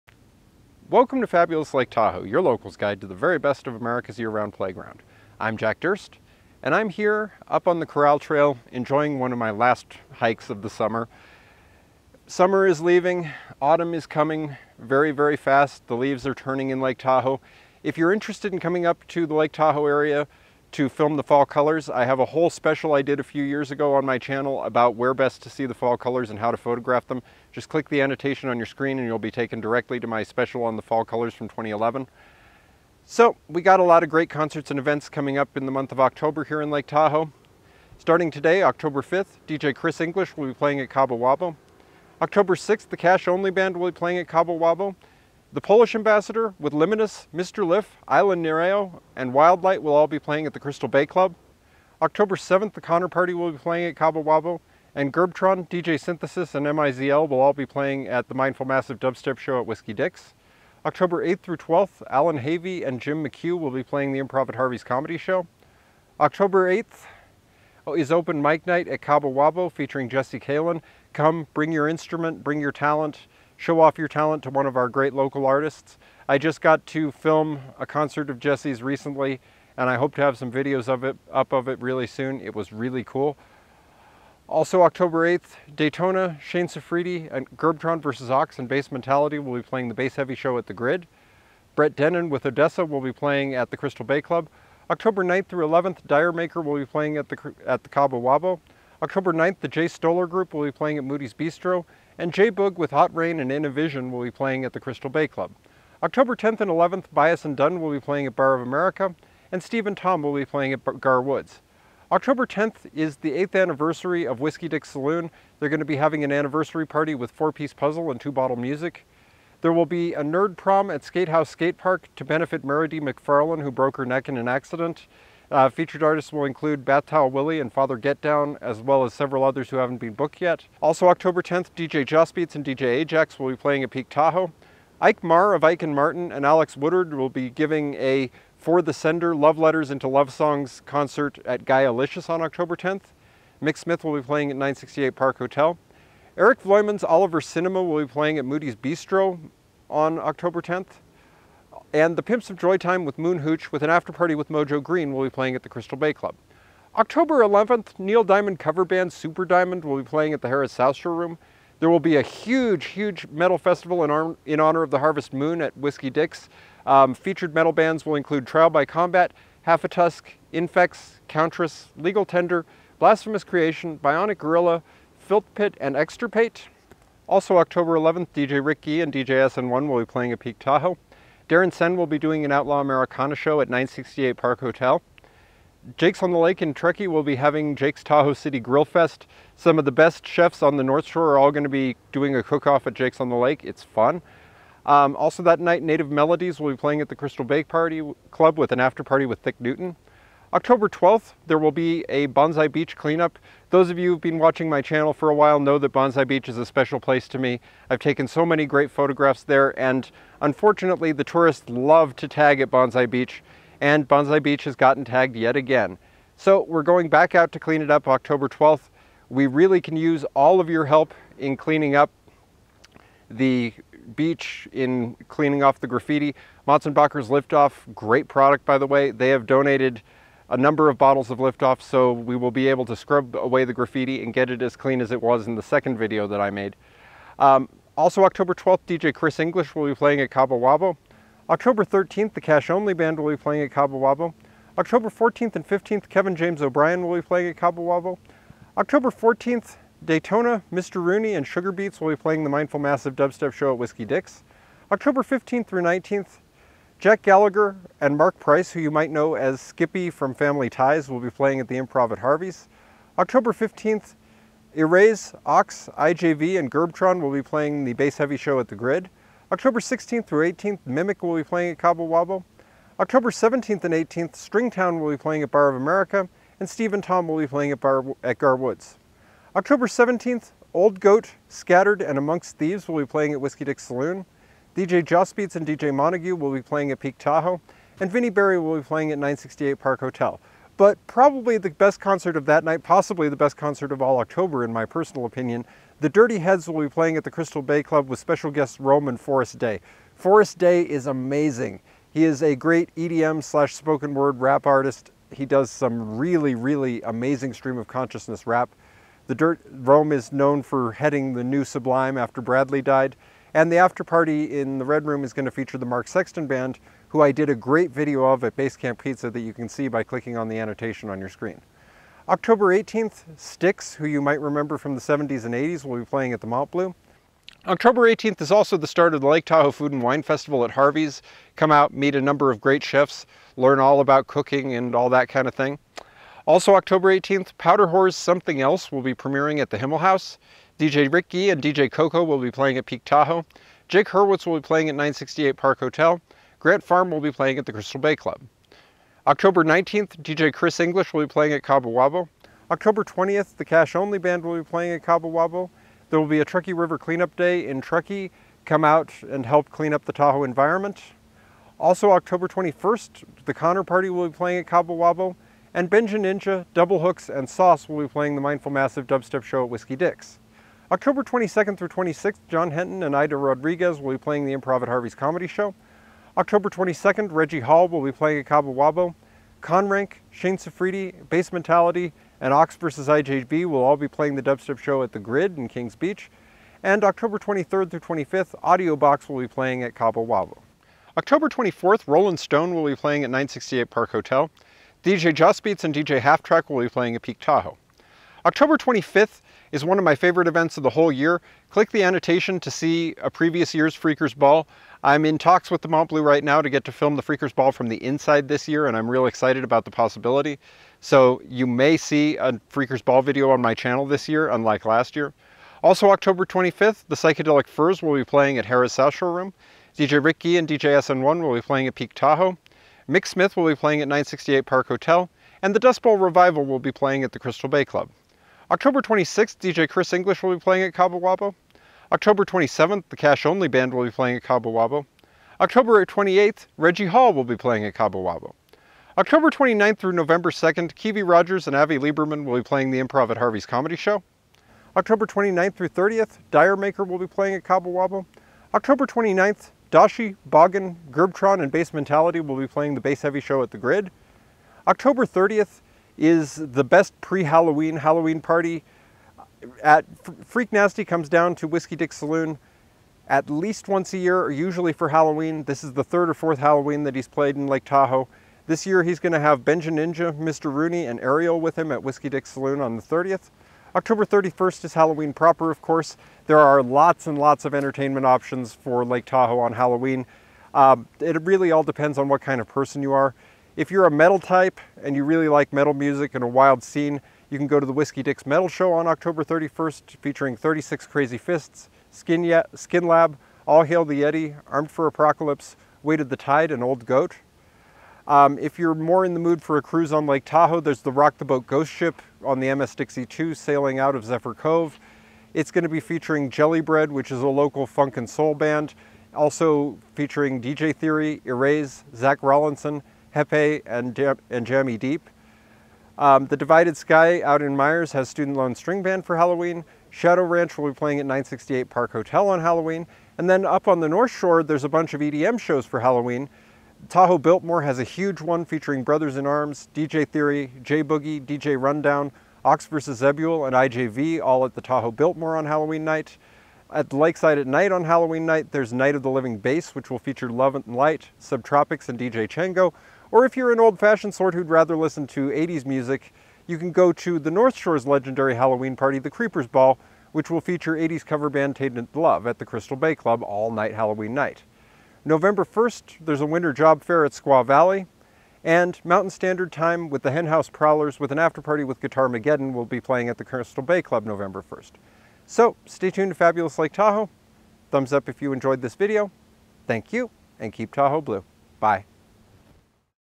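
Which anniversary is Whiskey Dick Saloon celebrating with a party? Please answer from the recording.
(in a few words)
8th.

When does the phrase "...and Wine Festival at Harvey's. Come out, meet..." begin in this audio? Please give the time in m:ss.
5:29.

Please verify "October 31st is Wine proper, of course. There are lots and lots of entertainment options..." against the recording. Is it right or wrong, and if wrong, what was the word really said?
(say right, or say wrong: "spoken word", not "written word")
wrong: "Halloween", not "Wine".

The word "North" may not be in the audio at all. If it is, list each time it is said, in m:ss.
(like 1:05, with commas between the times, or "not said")
3:10, 8:44, 9:07.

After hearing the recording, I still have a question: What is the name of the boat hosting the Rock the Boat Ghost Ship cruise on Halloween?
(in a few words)
MS Dixie 2.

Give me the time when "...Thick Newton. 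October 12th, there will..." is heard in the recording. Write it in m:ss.
3:19.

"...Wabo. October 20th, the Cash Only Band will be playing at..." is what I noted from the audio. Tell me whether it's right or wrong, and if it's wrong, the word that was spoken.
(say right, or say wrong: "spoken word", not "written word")
right.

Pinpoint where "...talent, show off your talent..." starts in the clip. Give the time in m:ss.
1:12.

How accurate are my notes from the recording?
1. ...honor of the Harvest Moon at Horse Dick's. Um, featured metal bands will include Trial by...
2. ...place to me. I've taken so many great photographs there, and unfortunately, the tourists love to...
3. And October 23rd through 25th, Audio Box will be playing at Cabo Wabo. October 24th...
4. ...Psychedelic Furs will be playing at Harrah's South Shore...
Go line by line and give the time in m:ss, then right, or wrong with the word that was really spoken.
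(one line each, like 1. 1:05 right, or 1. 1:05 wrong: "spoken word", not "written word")
1. 2:44 wrong: "Whiskey", not "Horse"
2. 3:26 right
3. 6:26 right
4. 6:57 right.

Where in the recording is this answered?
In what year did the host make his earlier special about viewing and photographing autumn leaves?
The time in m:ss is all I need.
0:31.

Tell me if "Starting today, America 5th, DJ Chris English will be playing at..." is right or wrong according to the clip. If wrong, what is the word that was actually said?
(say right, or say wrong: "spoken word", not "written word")
wrong: "October", not "America".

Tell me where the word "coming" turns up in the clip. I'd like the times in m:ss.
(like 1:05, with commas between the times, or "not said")
0:14, 0:18, 0:35.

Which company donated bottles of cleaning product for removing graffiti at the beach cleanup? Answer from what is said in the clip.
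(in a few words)
Motsenbocker's.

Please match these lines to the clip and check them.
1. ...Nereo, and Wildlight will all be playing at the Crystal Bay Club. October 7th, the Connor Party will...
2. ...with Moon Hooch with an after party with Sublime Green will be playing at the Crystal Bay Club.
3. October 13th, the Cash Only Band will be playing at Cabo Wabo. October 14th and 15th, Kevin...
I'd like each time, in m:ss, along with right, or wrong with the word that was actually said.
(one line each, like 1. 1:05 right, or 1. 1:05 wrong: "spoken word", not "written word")
1. 0:48 right
2. 2:33 wrong: "Mojo", not "Sublime"
3. 4:01 right.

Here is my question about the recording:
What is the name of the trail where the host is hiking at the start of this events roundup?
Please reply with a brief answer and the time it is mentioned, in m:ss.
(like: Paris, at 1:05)
Corral Trail, at 0:07.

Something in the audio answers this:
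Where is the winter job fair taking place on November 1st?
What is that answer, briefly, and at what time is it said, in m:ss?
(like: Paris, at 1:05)
Squaw Valley, at 9:17.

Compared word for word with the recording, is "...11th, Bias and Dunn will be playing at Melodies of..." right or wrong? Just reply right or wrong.
wrong.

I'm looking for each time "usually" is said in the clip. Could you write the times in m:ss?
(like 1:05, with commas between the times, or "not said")
7:44.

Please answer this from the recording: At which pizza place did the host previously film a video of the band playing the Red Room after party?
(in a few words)
Basecamp Pizza.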